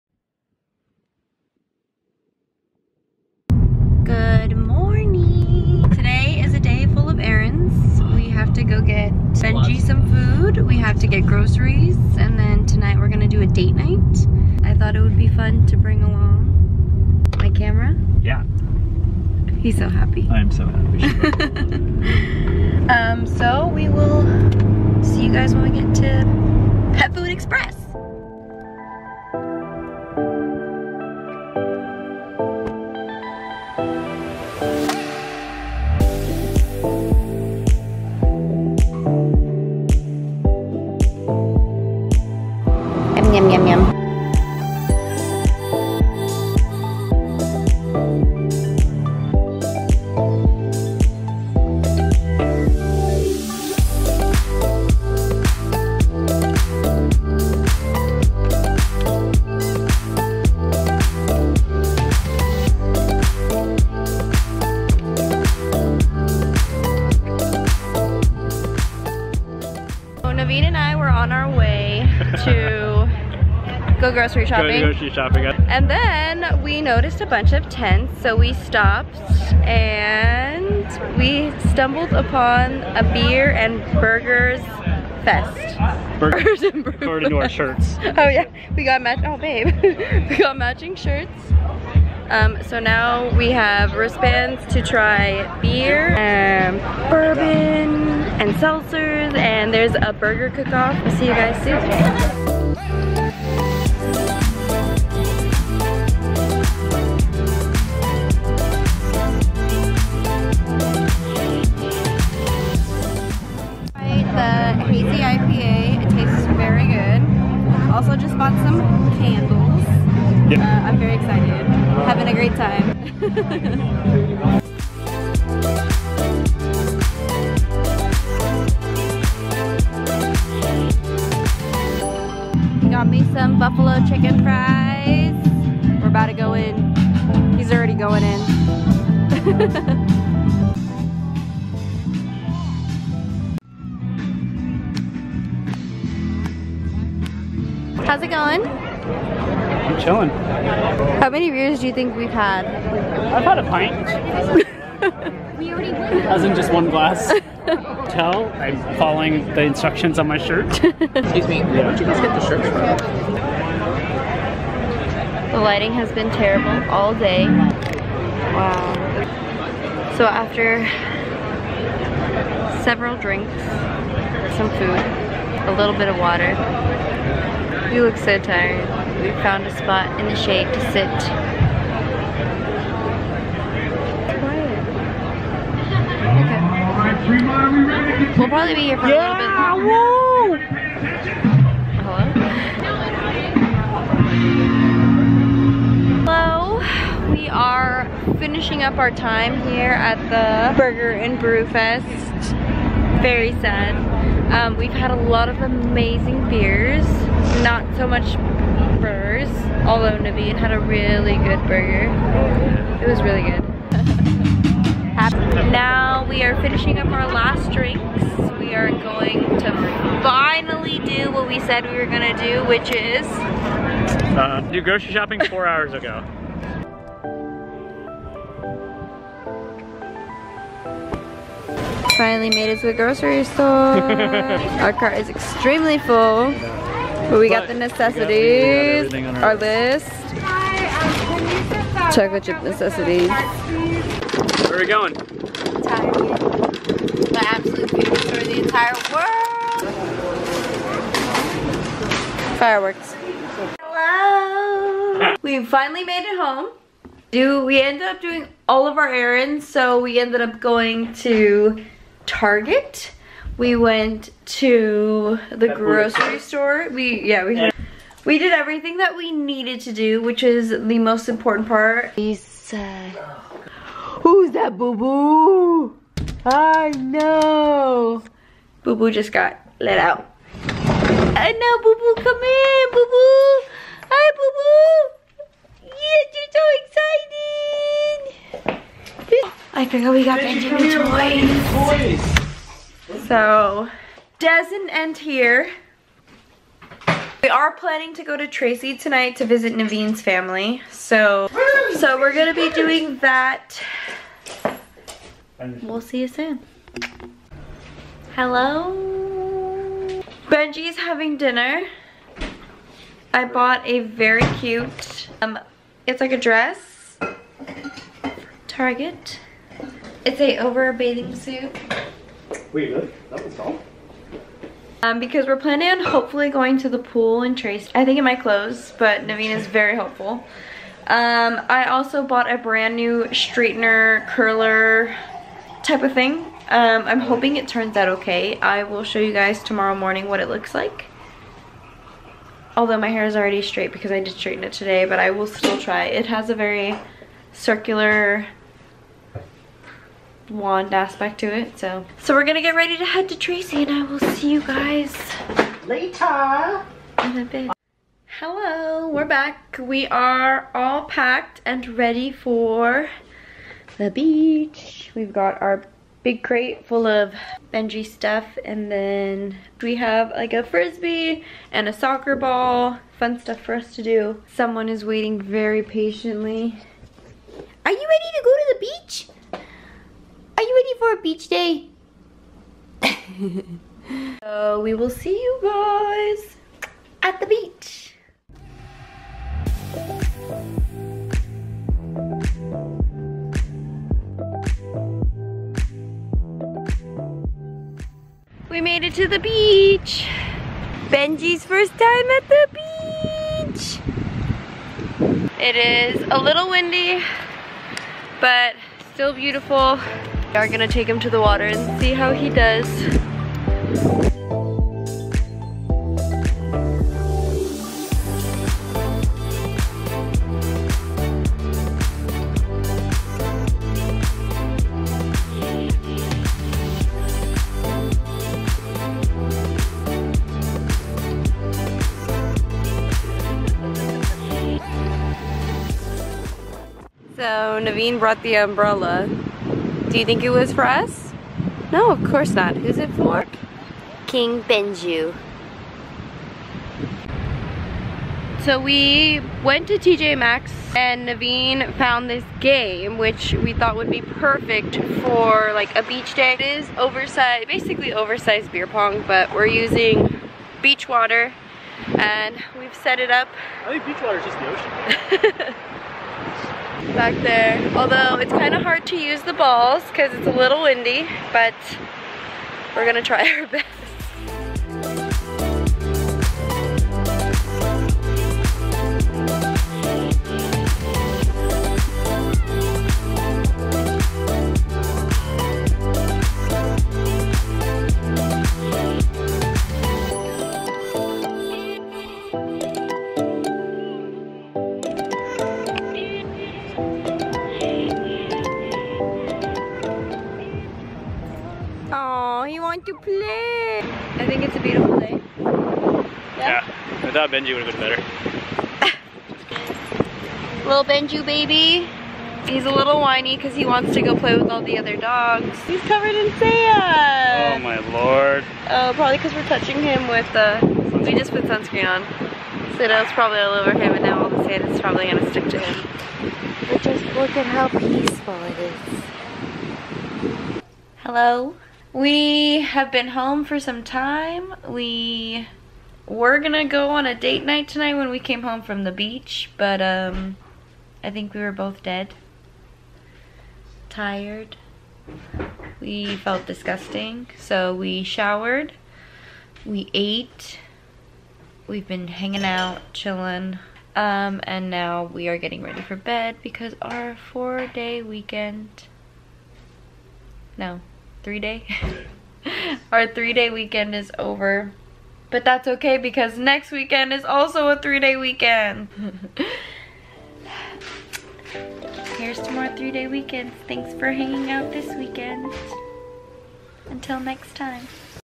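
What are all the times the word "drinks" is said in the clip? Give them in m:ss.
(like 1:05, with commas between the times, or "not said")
2:53, 3:37.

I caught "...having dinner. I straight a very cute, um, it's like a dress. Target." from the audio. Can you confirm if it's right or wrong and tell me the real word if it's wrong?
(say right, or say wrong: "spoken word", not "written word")
wrong: "bought", not "straight".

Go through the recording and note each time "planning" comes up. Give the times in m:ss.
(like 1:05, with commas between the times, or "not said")
4:57, 5:25.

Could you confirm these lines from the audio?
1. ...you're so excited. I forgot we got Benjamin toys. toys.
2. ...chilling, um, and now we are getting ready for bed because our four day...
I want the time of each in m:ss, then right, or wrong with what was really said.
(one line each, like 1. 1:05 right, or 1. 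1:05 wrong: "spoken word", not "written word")
1. 4:49 right
2. 9:13 right.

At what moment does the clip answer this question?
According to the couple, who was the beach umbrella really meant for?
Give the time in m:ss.
7:24.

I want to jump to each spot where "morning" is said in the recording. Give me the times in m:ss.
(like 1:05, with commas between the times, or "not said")
5:39.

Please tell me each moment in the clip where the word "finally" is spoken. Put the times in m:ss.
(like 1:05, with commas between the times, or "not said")
3:40, 3:52, 4:15.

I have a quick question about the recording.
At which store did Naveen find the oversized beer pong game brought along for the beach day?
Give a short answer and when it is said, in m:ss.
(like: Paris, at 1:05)
TJ Maxx, at 7:29.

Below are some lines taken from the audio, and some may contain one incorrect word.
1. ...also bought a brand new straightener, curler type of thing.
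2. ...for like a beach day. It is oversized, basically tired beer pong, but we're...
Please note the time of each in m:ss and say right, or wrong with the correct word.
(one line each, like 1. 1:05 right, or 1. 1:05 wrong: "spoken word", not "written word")
1. 5:31 right
2. 7:35 wrong: "oversized", not "tired".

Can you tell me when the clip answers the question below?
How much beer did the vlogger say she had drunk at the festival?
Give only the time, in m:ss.
2:33.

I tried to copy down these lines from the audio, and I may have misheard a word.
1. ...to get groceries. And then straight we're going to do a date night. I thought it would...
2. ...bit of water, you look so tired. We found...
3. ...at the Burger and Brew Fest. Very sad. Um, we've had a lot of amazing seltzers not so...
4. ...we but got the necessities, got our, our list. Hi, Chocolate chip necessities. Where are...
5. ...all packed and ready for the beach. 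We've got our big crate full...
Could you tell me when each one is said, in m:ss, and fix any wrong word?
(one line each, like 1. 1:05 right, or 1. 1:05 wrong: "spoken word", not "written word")
1. 0:10 wrong: "tonight", not "straight"
2. 2:55 right
3. 3:19 wrong: "beers", not "seltzers"
4. 3:57 right
5. 6:00 right.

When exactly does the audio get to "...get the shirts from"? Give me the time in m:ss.
2:42.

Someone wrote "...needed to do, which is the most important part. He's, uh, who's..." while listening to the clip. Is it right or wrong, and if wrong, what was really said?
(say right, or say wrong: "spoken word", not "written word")
right.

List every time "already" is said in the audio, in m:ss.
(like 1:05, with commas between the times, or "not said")
2:35, 5:43.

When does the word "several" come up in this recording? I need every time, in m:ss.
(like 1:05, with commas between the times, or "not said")
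2:52.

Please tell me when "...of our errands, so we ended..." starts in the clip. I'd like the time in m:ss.
4:18.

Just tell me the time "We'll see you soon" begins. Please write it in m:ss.
5:05.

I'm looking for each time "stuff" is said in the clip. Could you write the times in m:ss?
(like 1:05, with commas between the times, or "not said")
6:08, 6:13.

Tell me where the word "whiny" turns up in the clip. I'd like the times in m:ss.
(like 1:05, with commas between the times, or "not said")
8:33.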